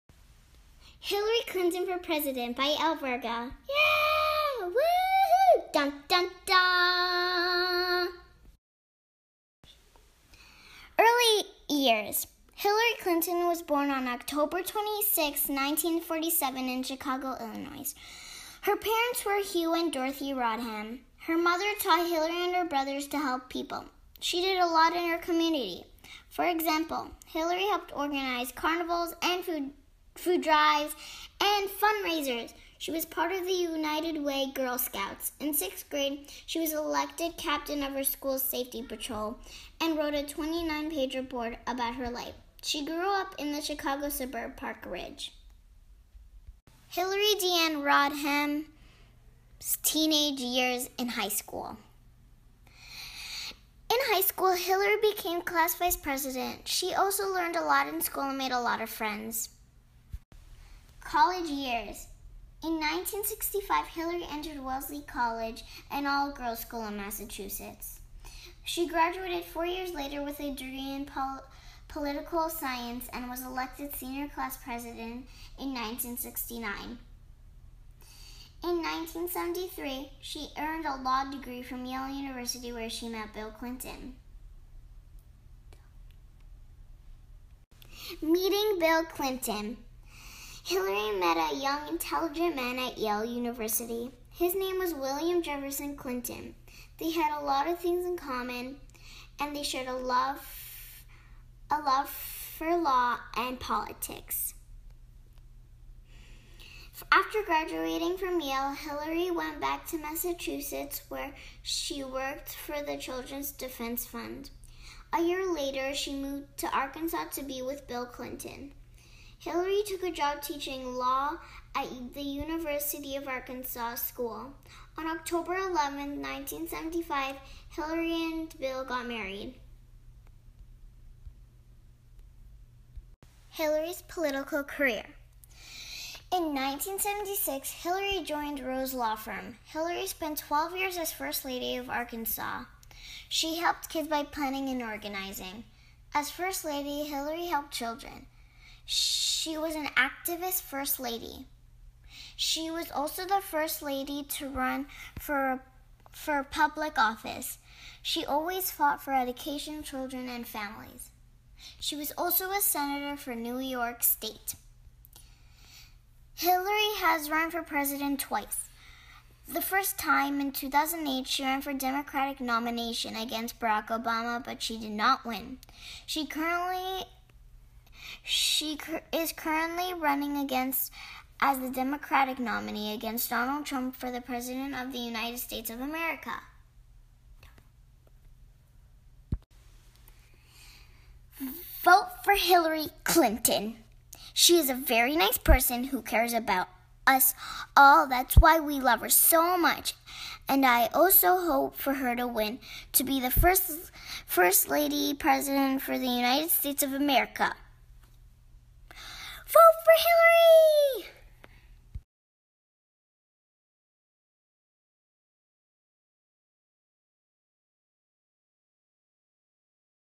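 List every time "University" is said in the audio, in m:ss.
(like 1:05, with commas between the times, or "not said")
1:22, 1:33, 2:02.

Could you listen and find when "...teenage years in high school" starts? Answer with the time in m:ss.
0:49.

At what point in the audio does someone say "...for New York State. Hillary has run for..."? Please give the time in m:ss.
2:43.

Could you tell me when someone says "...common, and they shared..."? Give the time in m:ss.
1:38.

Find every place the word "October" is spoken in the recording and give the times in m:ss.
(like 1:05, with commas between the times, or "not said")
0:14, 2:05.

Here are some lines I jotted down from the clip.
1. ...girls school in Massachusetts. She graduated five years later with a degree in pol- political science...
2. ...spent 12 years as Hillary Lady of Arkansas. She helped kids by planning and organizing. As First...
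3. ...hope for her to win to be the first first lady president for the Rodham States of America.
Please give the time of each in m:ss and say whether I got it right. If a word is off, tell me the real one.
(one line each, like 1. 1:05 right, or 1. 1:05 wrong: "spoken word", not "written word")
1. 1:06 wrong: "four", not "five"
2. 2:20 wrong: "First", not "Hillary"
3. 3:21 wrong: "United", not "Rodham".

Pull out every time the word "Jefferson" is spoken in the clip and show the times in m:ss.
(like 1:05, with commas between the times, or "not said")
1:35.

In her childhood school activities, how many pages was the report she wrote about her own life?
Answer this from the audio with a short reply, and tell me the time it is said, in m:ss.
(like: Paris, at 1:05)
29, at 0:40.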